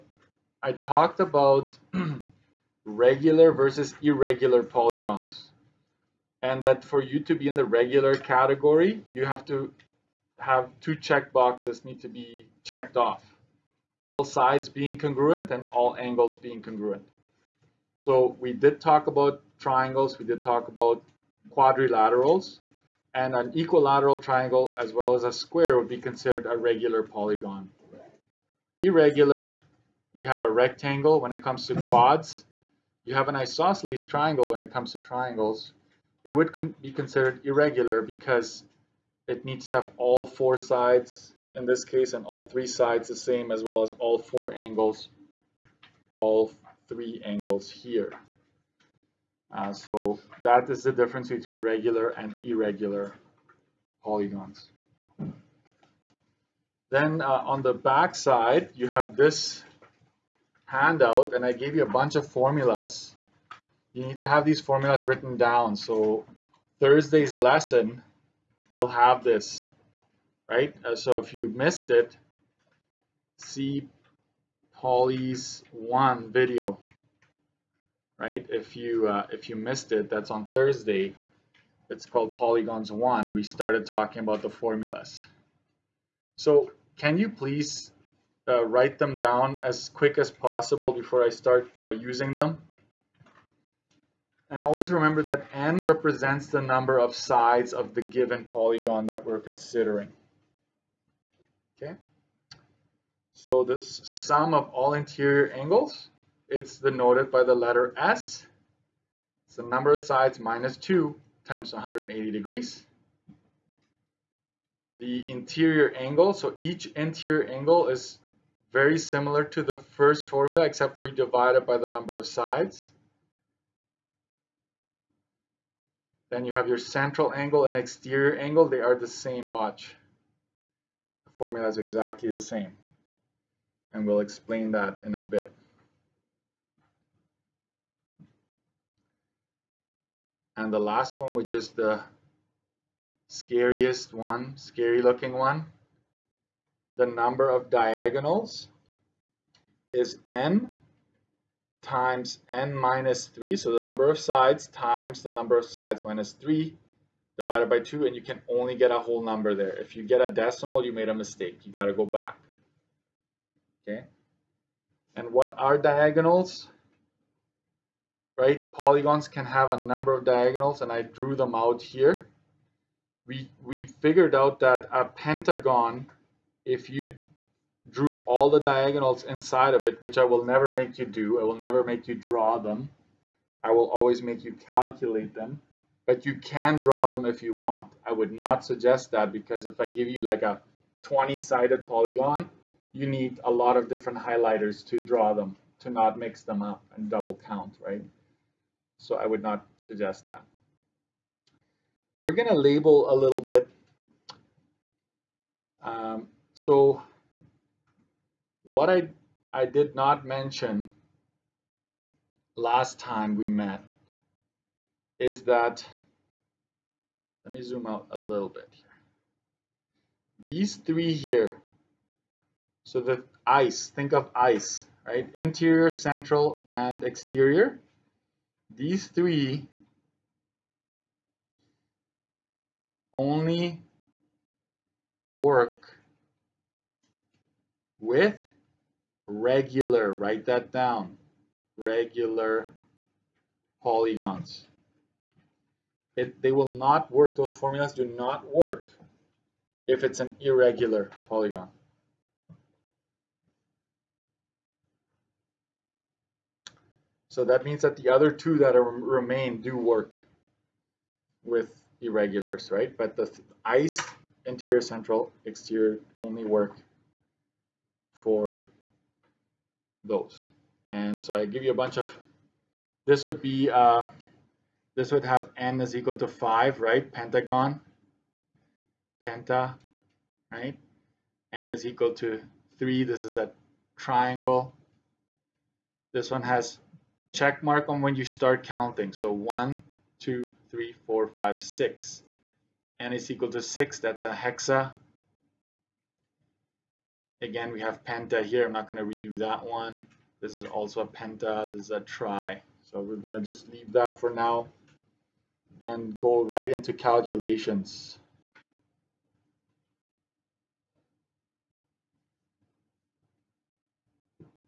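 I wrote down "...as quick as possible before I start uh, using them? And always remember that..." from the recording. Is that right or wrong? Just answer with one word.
right.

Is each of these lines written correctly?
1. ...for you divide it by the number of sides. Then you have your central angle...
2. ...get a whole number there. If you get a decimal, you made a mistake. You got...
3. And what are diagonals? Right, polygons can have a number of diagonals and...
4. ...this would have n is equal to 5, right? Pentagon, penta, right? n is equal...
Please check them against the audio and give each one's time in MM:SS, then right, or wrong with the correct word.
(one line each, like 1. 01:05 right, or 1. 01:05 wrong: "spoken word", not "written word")
1. 02:00 right
2. 02:38 right
3. 02:45 right
4. 04:34 right.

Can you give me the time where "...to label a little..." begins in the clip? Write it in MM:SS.
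03:22.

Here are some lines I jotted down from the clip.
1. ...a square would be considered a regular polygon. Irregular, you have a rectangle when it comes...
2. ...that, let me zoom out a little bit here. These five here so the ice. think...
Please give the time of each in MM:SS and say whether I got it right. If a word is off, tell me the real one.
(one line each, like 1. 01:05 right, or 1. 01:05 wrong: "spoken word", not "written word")
1. 00:25 right
2. 03:35 wrong: "three", not "five".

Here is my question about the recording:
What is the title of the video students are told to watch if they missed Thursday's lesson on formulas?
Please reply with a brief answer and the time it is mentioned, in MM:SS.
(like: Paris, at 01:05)
Polygons One, at 01:22.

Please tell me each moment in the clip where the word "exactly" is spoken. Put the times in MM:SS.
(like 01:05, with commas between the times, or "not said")
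02:11.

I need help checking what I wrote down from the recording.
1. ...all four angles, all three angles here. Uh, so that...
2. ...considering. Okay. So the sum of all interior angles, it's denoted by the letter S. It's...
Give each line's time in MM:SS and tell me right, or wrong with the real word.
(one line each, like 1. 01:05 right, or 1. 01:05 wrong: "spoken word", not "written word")
1. 00:43 right
2. 01:39 right.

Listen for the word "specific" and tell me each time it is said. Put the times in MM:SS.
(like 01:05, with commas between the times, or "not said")
not said.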